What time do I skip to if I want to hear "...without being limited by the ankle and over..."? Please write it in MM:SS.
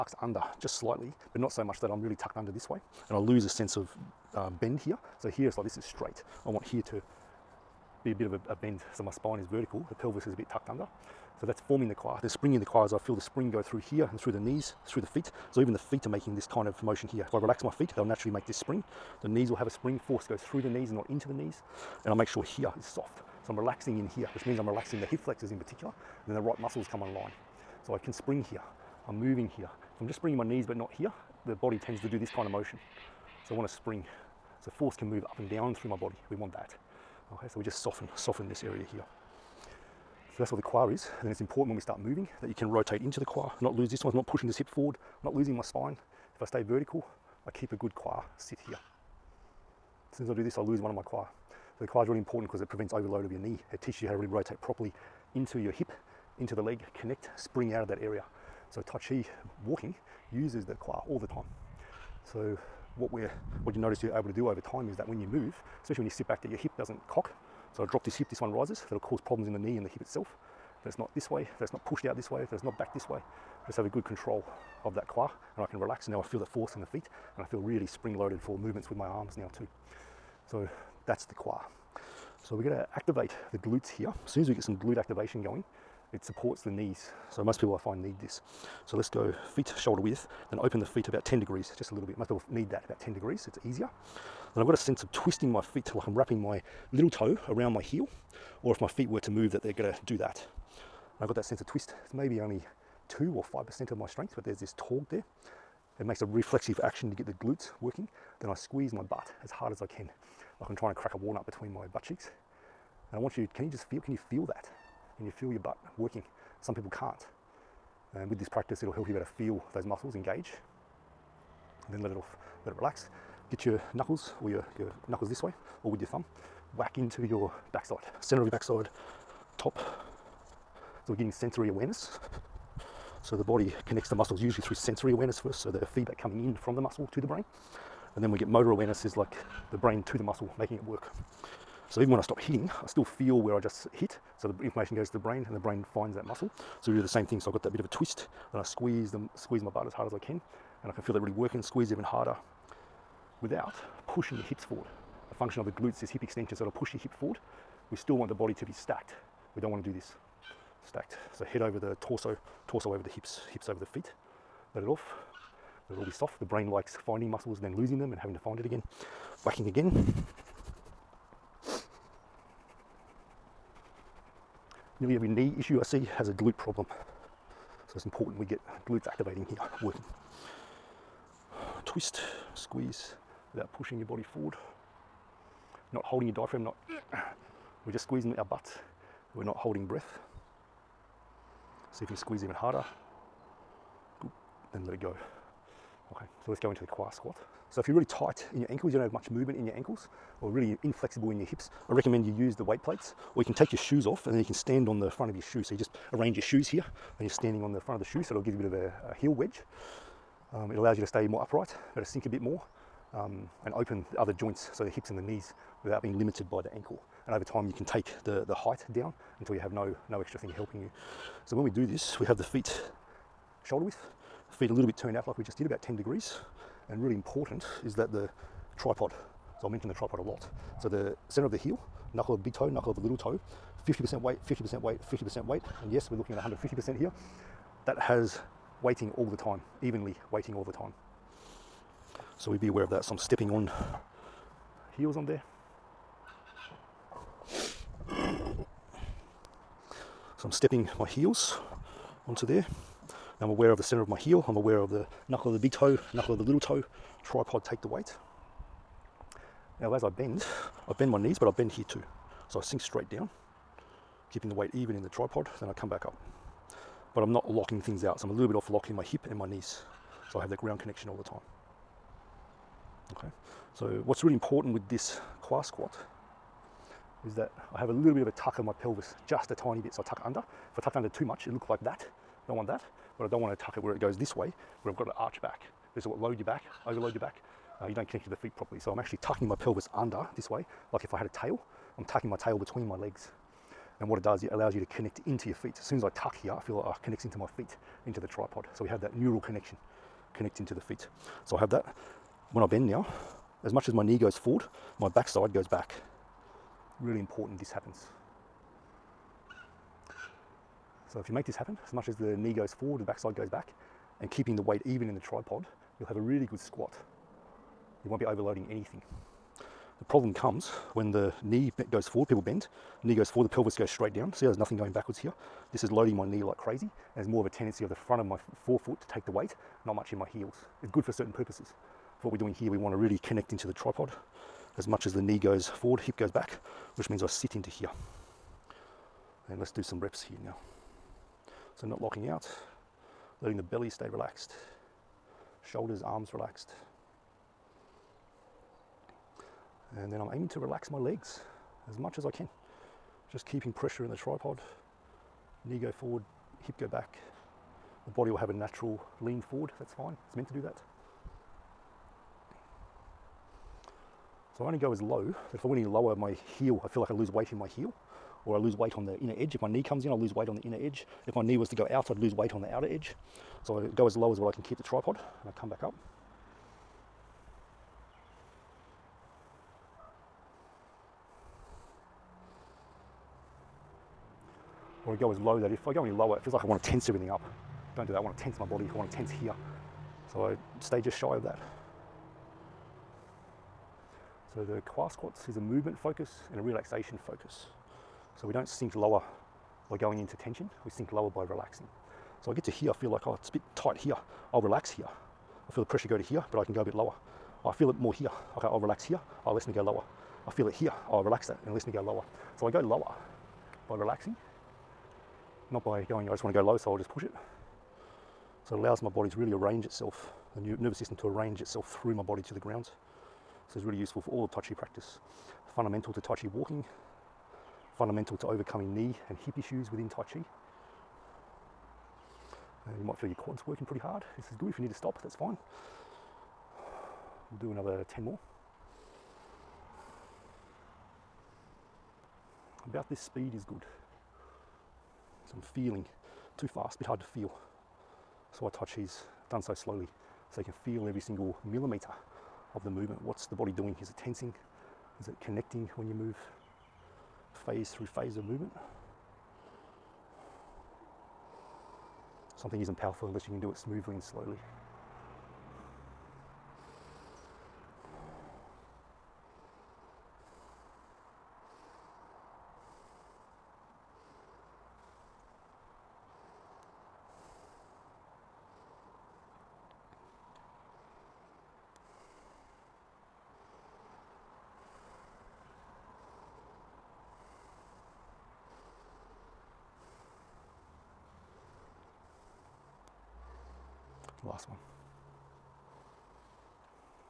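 03:35.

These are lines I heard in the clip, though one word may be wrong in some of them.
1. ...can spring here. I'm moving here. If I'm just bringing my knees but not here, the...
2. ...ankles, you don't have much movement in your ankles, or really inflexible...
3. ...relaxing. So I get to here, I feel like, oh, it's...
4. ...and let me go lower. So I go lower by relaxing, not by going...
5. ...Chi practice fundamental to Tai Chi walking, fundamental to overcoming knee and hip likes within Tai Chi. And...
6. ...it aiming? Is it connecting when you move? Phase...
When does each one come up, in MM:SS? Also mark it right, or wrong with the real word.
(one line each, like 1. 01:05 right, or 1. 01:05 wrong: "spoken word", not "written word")
1. 00:27 right
2. 03:18 right
3. 06:41 right
4. 06:51 right
5. 07:04 wrong: "issues", not "likes"
6. 07:34 wrong: "tensing", not "aiming".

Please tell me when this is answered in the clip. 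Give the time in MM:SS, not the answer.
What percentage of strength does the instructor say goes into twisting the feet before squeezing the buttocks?
01:43.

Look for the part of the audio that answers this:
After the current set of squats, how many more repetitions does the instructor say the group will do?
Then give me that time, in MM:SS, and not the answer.
07:17.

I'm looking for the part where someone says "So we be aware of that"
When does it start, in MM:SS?
04:02.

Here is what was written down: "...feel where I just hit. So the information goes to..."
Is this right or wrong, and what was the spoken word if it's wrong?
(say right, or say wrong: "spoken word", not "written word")
right.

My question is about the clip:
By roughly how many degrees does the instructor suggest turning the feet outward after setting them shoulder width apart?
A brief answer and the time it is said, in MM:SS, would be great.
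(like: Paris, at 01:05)
10 degrees, at 01:32.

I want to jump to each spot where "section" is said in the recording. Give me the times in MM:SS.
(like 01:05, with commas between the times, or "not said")
not said.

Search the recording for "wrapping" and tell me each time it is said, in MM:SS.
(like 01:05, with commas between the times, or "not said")
01:36.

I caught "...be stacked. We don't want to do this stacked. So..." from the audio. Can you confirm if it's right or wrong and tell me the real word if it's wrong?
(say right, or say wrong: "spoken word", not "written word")
right.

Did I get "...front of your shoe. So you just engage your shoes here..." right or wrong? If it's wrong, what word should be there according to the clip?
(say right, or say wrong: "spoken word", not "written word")
wrong: "arrange", not "engage".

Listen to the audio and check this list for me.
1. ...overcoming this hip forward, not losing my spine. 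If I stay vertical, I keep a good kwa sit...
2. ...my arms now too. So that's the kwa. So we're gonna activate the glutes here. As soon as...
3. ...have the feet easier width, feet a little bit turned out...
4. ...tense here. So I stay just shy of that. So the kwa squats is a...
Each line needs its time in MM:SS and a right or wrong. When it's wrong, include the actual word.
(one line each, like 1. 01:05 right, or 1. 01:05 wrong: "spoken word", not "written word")
1. 00:44 wrong: "pushing", not "overcoming"
2. 01:18 right
3. 03:42 wrong: "shoulder", not "easier"
4. 06:29 right.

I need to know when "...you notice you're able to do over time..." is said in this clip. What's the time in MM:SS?
01:03.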